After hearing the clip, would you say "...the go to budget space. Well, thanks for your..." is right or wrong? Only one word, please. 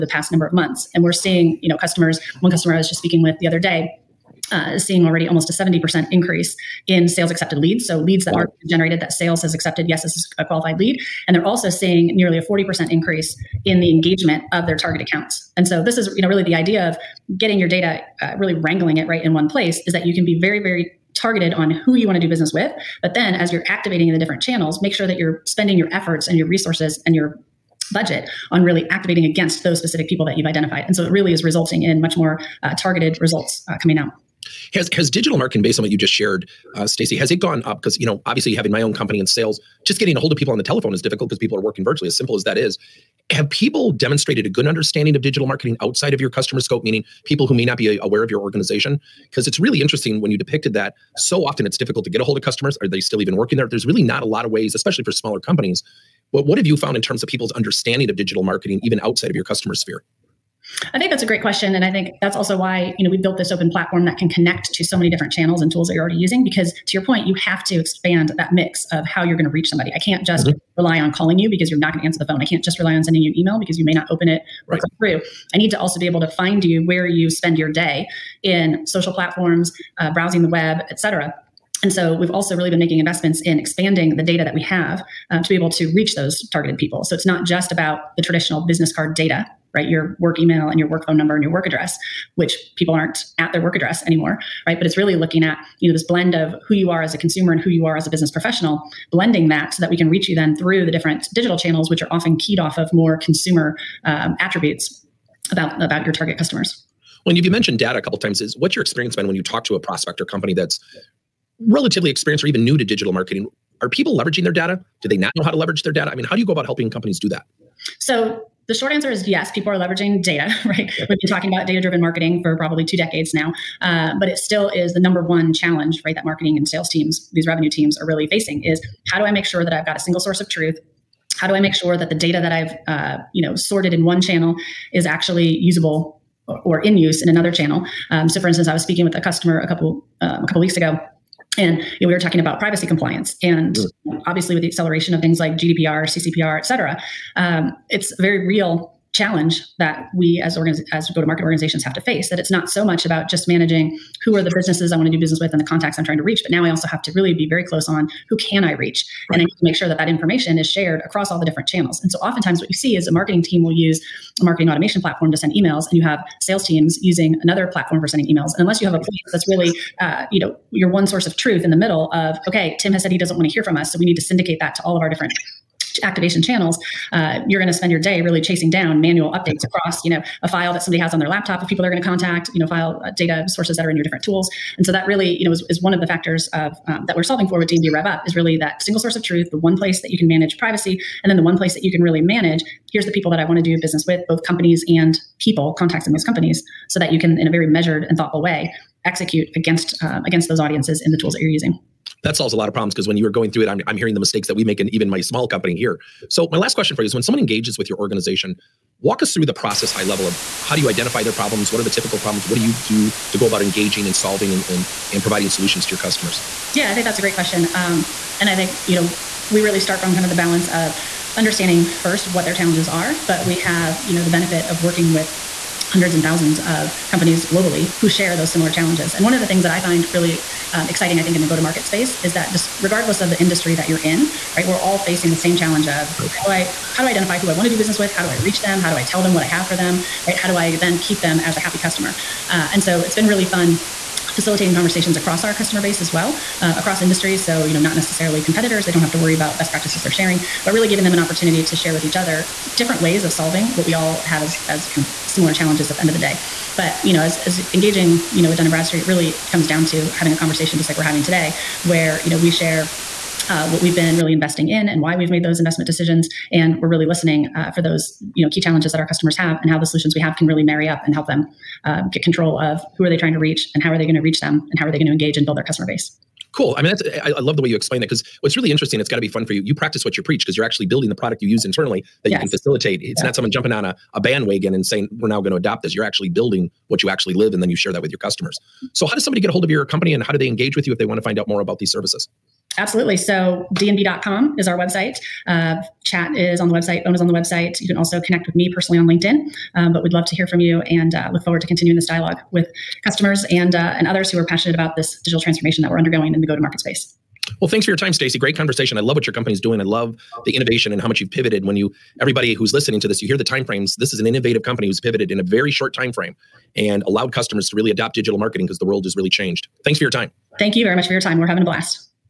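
wrong.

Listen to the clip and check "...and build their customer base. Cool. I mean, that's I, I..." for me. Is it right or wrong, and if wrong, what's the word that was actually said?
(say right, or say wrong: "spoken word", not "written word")
right.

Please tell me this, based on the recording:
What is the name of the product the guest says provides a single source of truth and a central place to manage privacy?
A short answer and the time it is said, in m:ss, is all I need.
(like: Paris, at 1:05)
D&B Rev Up, at 3:07.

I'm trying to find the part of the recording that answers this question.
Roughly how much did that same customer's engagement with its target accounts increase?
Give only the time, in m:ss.
0:12.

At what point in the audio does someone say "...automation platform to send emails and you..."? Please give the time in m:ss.
2:44.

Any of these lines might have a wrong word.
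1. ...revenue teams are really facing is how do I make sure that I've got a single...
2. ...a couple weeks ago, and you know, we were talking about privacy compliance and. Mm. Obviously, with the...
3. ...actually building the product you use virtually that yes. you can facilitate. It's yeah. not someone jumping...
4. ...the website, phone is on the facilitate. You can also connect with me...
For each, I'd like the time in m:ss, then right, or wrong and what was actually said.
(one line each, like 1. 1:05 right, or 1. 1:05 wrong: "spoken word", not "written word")
1. 2:07 right
2. 2:20 right
3. 4:40 wrong: "internally", not "virtually"
4. 4:56 wrong: "website", not "facilitate".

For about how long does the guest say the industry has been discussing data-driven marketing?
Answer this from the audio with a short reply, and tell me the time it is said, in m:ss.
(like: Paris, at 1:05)
two decades, at 2:02.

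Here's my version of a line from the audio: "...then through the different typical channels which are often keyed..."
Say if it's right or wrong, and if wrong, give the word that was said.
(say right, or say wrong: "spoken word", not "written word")
wrong: "digital", not "typical".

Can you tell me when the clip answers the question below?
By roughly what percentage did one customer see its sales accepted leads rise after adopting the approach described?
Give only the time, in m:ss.
0:05.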